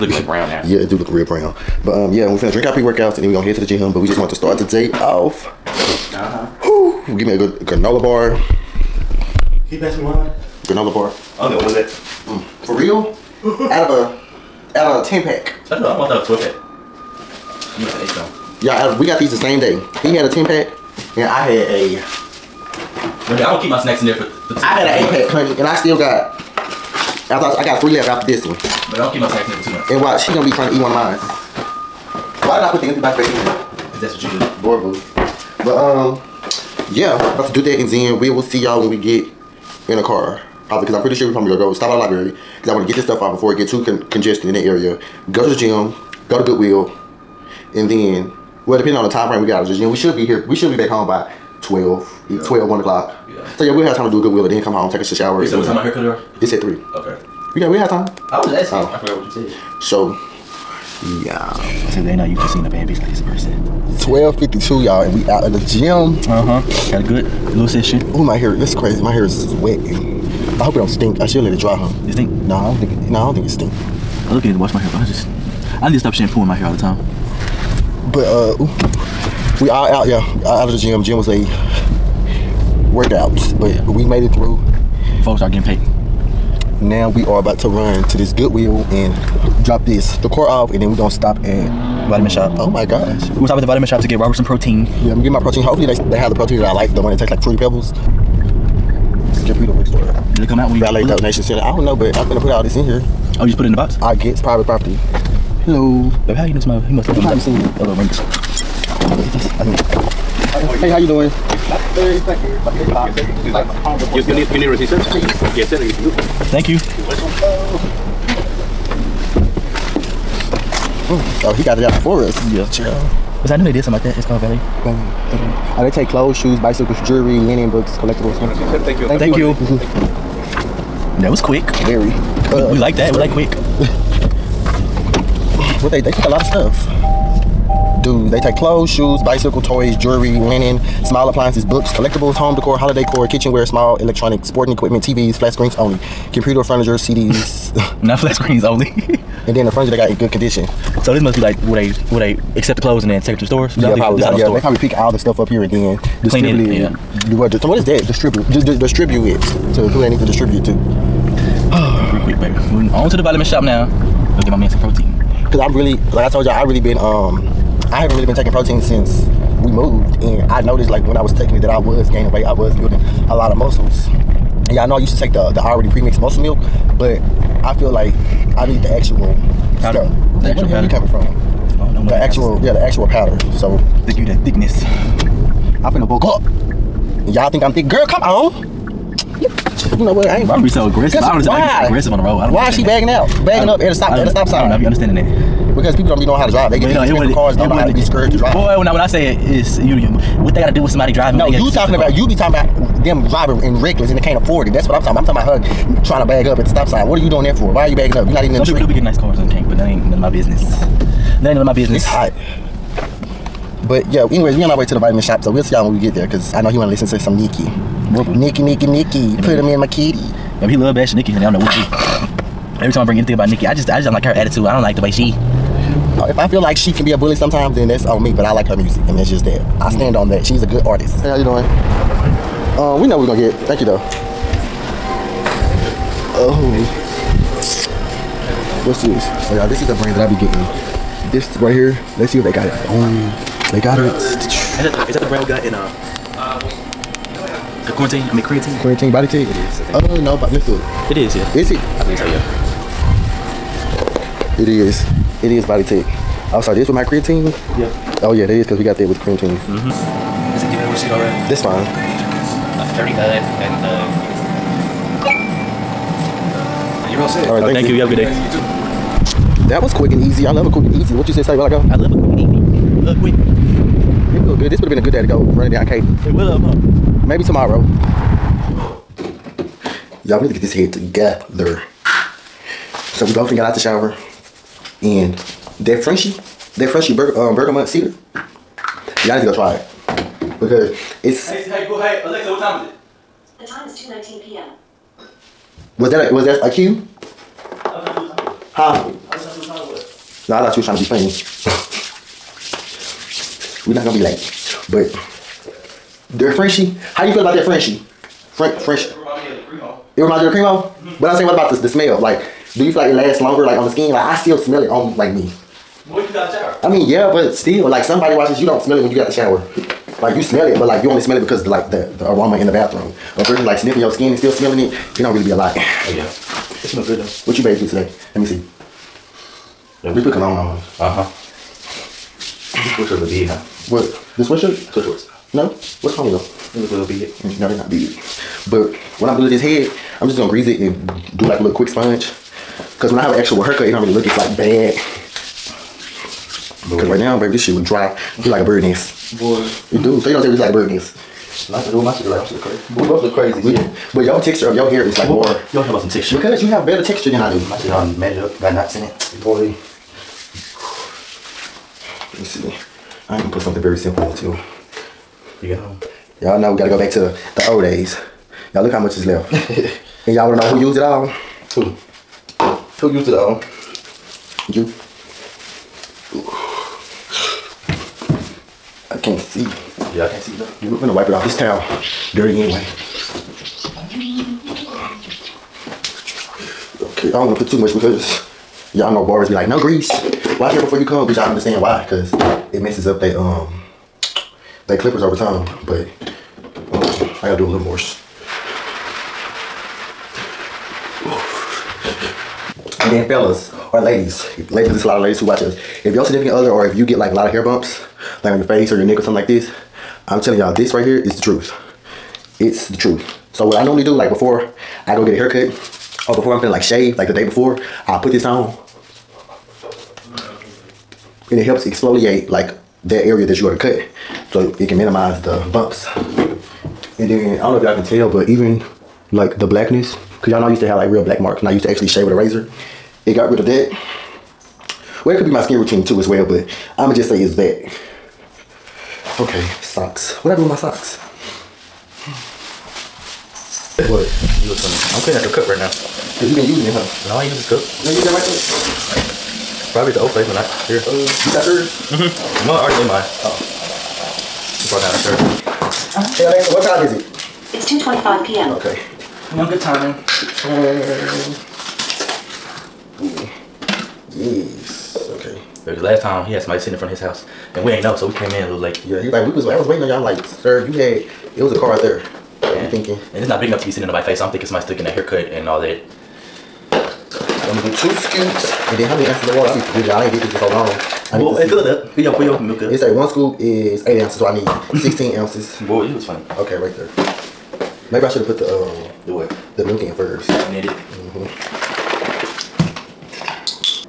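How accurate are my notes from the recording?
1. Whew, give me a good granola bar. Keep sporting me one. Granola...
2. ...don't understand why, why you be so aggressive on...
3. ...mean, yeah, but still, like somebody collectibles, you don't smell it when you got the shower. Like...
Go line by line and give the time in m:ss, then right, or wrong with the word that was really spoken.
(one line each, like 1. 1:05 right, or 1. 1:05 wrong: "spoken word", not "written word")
1. 0:06 wrong: "passing", not "sporting"
2. 3:11 right
3. 5:16 wrong: "watches", not "collectibles".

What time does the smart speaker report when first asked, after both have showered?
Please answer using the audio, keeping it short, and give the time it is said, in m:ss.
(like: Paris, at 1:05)
2:19 p.m., at 4:53.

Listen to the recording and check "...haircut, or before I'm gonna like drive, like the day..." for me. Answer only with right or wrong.
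wrong.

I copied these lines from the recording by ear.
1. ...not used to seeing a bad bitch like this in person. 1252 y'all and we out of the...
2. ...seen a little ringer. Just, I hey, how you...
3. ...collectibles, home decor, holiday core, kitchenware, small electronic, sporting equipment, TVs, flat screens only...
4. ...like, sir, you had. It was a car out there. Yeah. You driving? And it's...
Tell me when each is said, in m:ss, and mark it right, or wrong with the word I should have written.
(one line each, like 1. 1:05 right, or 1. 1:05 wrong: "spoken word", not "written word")
1. 1:02 right
2. 1:47 right
3. 2:21 right
4. 7:50 wrong: "thinking", not "driving".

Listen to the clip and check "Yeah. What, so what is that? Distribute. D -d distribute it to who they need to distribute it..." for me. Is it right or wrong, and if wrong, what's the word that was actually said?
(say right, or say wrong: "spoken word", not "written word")
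right.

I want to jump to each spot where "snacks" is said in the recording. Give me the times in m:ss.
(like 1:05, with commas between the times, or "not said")
0:23, 0:29.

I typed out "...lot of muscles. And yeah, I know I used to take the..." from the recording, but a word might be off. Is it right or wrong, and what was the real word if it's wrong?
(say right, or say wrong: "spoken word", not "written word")
right.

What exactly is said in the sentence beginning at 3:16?
They get well, these expensive cars, don't know how to be scared to drive.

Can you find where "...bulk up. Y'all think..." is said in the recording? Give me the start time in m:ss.
3:06.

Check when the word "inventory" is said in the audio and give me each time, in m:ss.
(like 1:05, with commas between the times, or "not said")
not said.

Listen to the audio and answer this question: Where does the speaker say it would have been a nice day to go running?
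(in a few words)
Katy.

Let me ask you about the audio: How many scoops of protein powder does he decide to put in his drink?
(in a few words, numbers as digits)
2.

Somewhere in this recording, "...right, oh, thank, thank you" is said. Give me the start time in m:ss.
4:27.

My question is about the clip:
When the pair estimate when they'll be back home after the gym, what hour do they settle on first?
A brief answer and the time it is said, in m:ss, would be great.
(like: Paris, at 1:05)
12, at 0:50.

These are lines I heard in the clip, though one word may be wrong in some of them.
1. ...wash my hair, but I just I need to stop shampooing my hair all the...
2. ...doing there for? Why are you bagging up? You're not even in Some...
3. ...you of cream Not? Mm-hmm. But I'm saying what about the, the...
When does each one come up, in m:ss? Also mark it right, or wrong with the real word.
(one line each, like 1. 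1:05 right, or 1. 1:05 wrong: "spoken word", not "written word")
1. 1:14 right
2. 3:27 right
3. 5:10 wrong: "Cremo", not "Not".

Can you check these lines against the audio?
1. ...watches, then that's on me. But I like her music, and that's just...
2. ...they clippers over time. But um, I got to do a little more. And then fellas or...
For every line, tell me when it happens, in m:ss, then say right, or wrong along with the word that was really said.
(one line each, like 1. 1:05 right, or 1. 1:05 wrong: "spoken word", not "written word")
1. 3:47 wrong: "sometimes", not "watches"
2. 6:34 right.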